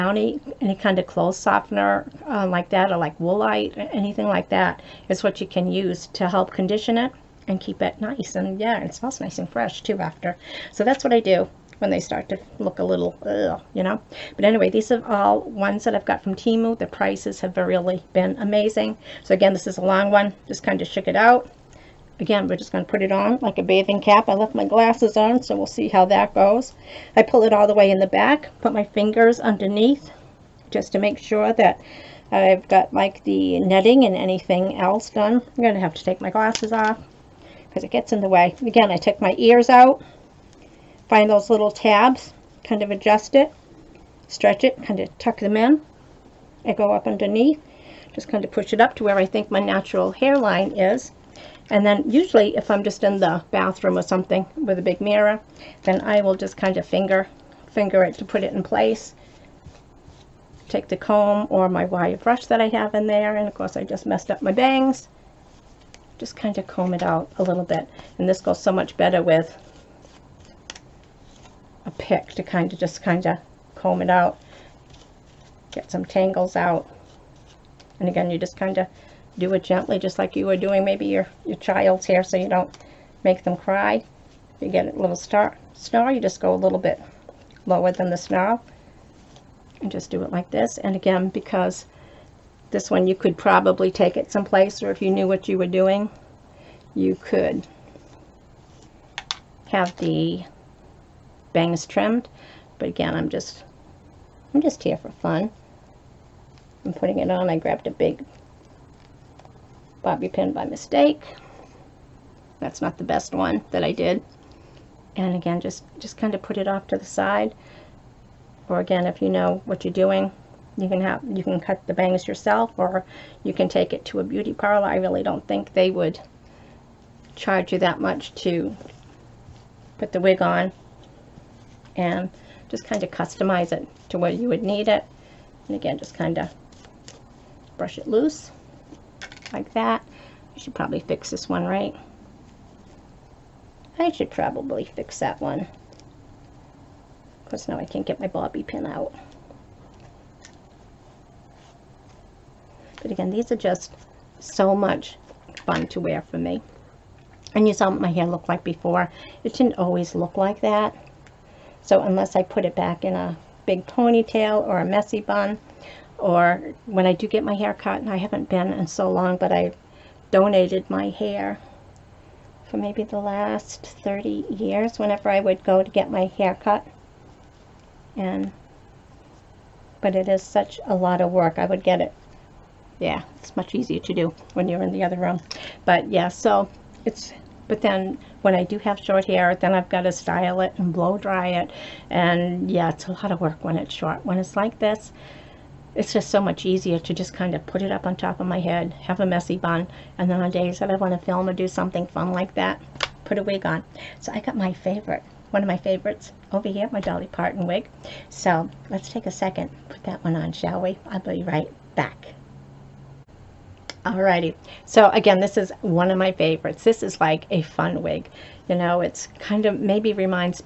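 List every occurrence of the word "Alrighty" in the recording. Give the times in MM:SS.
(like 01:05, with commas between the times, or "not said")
03:34.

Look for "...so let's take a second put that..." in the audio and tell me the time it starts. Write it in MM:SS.
03:28.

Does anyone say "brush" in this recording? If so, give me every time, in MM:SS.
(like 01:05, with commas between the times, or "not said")
01:02, 02:17.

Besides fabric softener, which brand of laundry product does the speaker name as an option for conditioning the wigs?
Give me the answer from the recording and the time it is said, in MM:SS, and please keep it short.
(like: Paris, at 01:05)
Woolite, at 00:03.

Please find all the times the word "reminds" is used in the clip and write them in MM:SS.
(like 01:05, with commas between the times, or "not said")
03:40.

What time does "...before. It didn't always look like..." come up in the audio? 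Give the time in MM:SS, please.
02:38.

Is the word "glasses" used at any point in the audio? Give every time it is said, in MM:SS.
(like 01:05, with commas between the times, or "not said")
00:24, 00:36.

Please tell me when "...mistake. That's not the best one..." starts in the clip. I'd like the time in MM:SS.
01:50.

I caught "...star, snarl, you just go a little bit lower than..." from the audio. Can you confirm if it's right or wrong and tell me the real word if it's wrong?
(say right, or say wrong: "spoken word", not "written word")
right.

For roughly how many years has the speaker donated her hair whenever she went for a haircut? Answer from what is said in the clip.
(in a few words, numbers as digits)
30.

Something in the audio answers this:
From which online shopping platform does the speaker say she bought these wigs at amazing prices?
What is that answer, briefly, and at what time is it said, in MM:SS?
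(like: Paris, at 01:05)
Temu, at 00:16.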